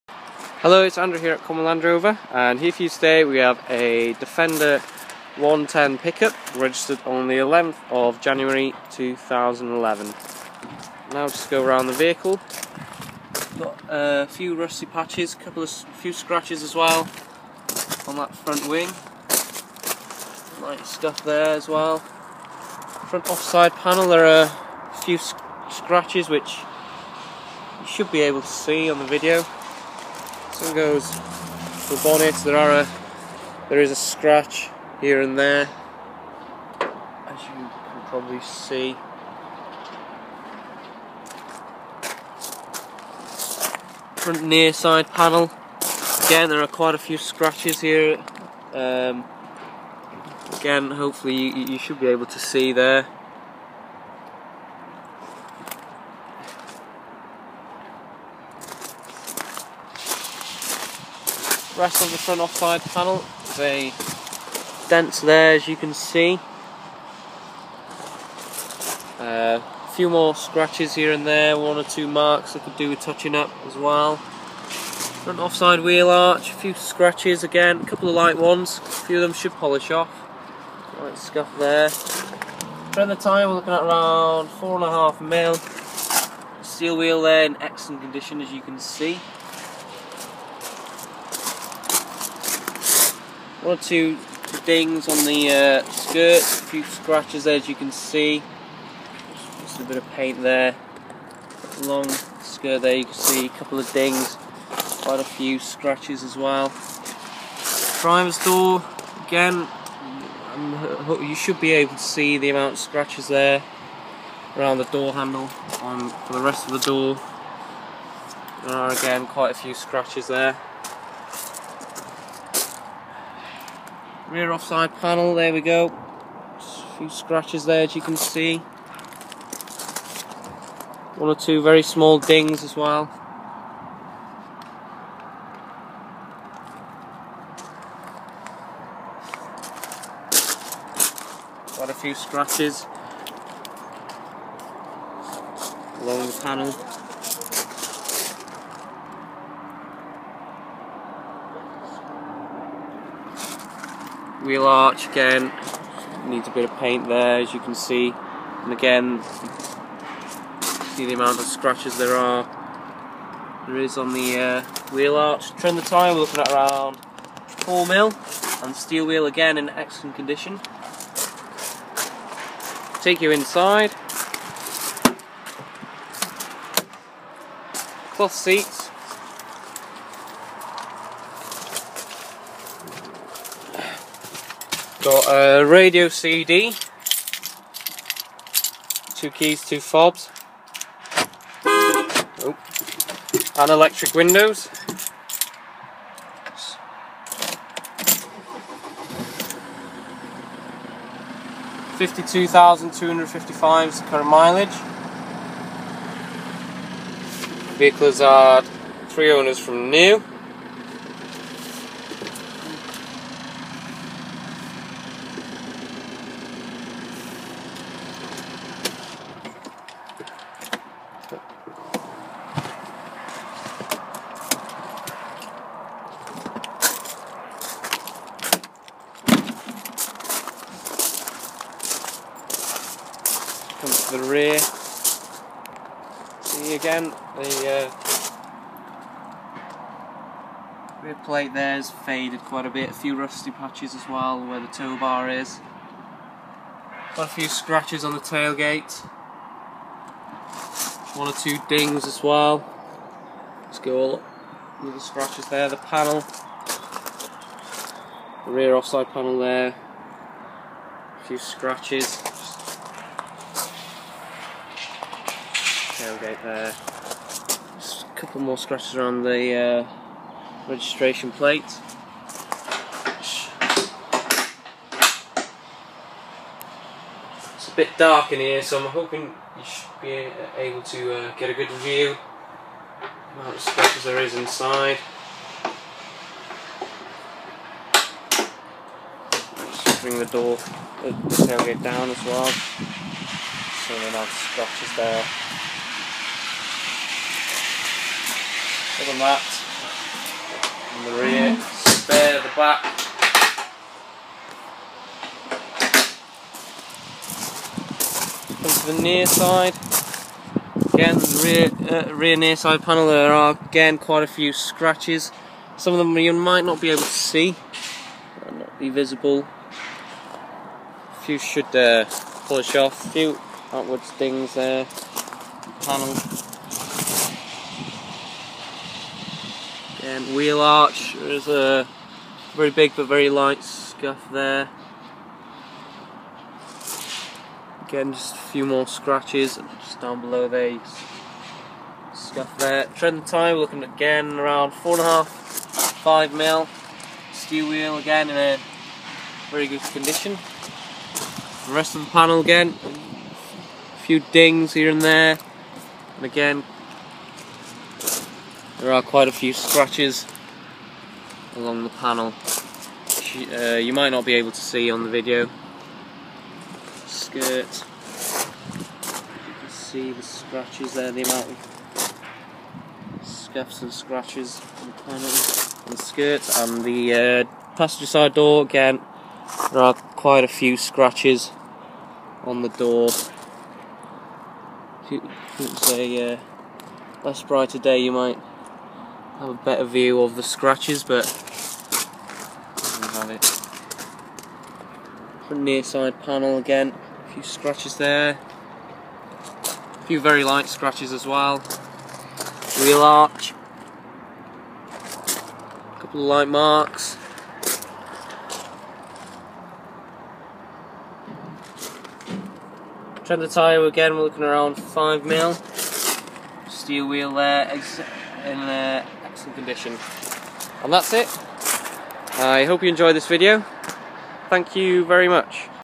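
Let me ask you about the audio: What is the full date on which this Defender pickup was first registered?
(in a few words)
11 January 2011.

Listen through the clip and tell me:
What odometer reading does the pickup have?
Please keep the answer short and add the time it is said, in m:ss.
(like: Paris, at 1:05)
52,255, at 3:21.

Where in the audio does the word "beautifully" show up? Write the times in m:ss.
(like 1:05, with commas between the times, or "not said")
not said.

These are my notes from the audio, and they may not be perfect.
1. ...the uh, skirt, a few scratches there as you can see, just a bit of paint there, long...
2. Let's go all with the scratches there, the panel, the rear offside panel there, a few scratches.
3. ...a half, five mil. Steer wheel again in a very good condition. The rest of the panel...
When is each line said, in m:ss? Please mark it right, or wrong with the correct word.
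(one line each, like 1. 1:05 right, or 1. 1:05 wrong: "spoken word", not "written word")
1. 1:35 right
2. 4:13 right
3. 5:45 right.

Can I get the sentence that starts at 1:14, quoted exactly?
Front offside wheel arch, a few scratches again, a couple of light ones, a few of them should polish off.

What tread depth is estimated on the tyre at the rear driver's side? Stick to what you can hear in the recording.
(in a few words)
4 mm.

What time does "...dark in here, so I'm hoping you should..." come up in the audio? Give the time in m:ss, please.
4:37.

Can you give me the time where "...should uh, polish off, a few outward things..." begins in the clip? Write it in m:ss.
5:21.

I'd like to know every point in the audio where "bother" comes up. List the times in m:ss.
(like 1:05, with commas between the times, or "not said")
not said.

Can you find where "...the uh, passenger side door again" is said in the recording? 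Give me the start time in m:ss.
6:16.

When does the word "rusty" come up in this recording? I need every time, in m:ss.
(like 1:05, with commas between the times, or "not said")
0:14, 4:03.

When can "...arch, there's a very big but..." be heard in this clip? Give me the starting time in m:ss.
5:30.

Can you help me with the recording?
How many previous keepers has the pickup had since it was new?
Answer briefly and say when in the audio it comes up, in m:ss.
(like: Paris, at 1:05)
3, at 3:29.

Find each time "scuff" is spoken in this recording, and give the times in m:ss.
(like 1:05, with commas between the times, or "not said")
1:21, 5:33, 5:42, 6:13.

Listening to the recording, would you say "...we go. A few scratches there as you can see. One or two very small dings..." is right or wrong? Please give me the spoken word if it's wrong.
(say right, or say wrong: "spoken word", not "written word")
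right.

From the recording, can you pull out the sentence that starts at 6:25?
It's a uh, less bright a day, you might have a better view of the scratches, but have it.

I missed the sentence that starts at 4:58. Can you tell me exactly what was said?
other than that, on the rear, mm-hmm.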